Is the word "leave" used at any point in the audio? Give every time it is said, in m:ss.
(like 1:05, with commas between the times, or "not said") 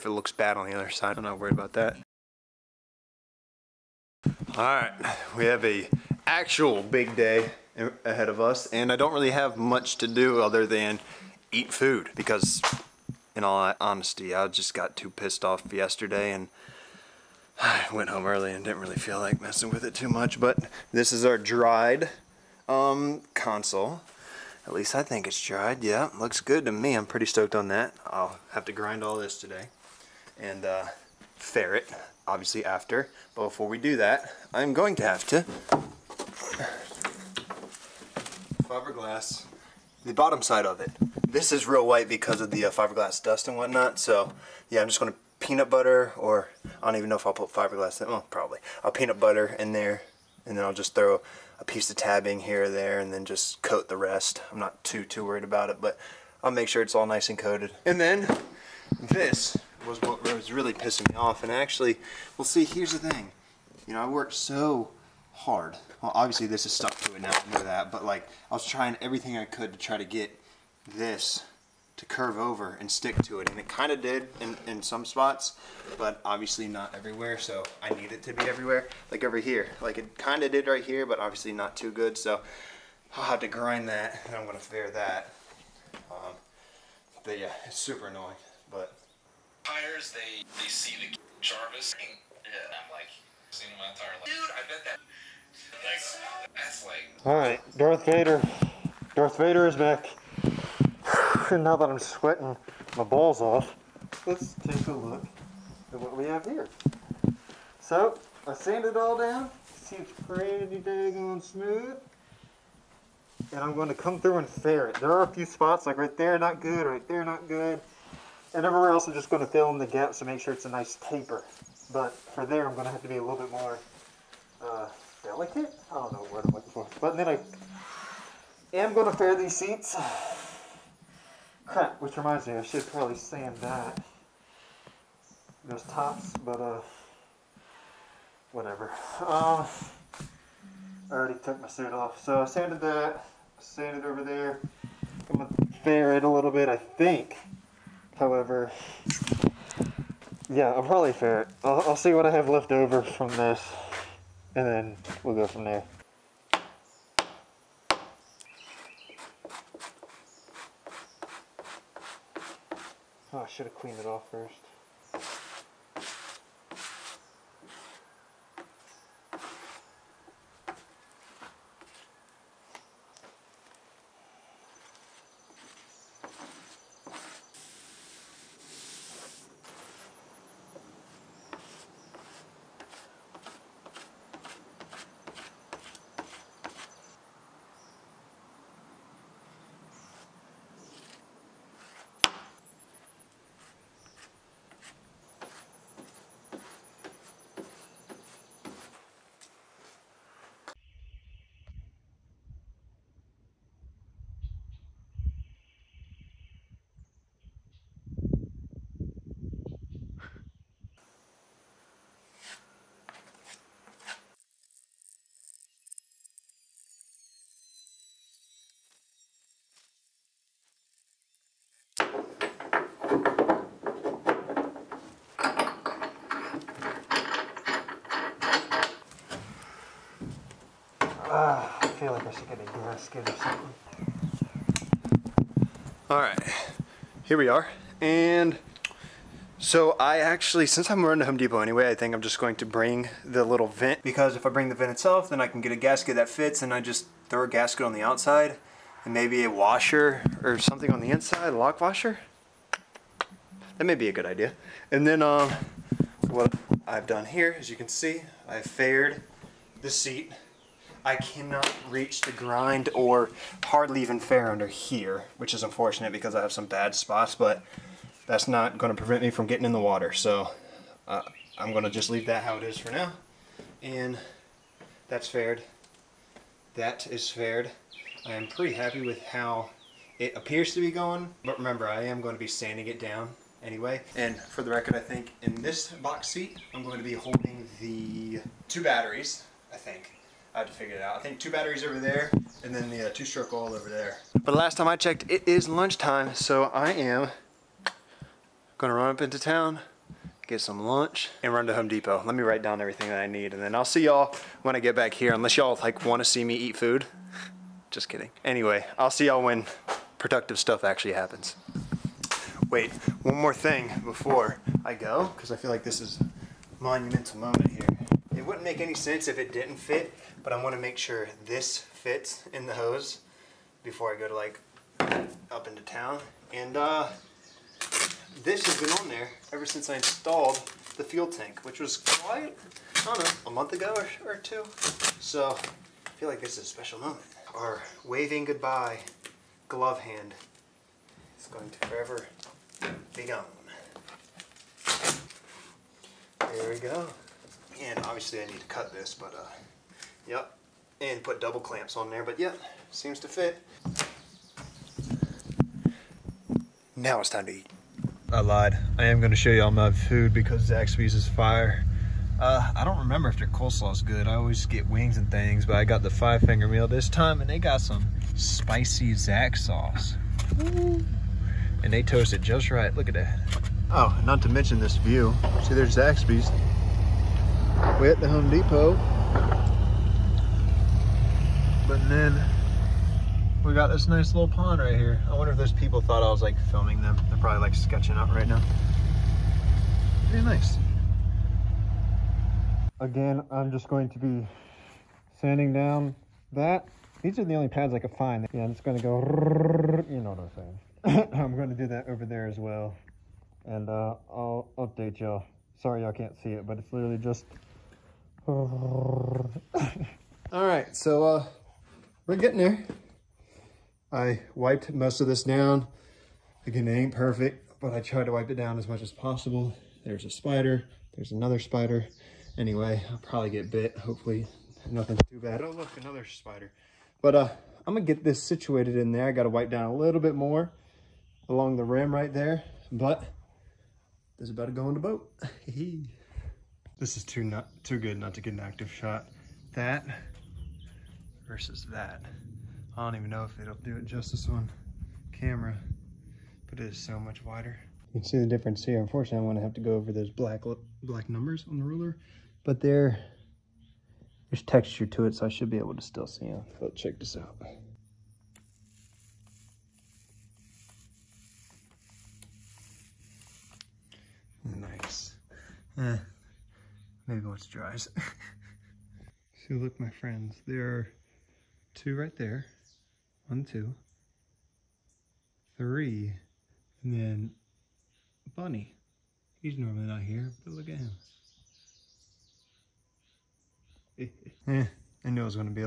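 4:32.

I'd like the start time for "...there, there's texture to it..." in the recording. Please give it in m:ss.
7:32.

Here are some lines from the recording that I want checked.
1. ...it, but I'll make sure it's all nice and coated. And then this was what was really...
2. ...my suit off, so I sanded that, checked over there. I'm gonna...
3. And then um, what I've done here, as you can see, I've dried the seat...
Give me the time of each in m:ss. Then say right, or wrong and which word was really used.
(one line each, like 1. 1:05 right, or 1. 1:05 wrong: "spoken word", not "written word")
1. 0:55 right
2. 2:21 wrong: "sanded", not "checked"
3. 4:14 wrong: "faired", not "dried".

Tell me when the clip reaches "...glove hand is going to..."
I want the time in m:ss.
5:39.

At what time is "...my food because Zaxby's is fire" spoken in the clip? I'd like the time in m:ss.
5:59.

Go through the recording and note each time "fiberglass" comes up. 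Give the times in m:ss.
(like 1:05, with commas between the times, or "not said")
0:38, 0:42, 0:47.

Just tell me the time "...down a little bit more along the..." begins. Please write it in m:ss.
7:09.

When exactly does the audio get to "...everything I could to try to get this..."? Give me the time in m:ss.
1:08.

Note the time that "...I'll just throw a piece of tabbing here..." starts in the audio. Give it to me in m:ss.
0:50.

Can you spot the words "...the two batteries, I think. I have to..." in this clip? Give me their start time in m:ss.
4:47.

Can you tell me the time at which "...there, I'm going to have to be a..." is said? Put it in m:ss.
2:02.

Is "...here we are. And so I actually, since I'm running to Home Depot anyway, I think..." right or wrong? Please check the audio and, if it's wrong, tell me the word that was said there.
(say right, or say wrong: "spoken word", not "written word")
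right.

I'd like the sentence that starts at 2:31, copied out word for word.
I'll, I'll see what I have left over from this, and then we'll go from there.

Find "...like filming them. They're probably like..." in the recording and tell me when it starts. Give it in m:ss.
6:26.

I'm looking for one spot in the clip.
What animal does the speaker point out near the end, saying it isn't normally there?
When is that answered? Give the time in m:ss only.
7:58.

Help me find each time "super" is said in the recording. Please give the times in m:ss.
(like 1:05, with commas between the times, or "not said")
1:27.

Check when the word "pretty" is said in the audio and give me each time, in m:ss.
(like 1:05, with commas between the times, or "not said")
0:27, 1:50, 4:38, 6:30.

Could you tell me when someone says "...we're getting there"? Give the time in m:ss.
6:52.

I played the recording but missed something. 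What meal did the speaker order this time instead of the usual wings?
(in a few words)
Five finger meal.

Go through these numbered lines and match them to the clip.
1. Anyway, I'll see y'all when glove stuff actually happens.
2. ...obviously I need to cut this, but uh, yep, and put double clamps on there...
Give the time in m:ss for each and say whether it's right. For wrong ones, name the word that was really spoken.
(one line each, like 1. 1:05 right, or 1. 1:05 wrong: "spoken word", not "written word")
1. 5:08 wrong: "productive", not "glove"
2. 5:47 right.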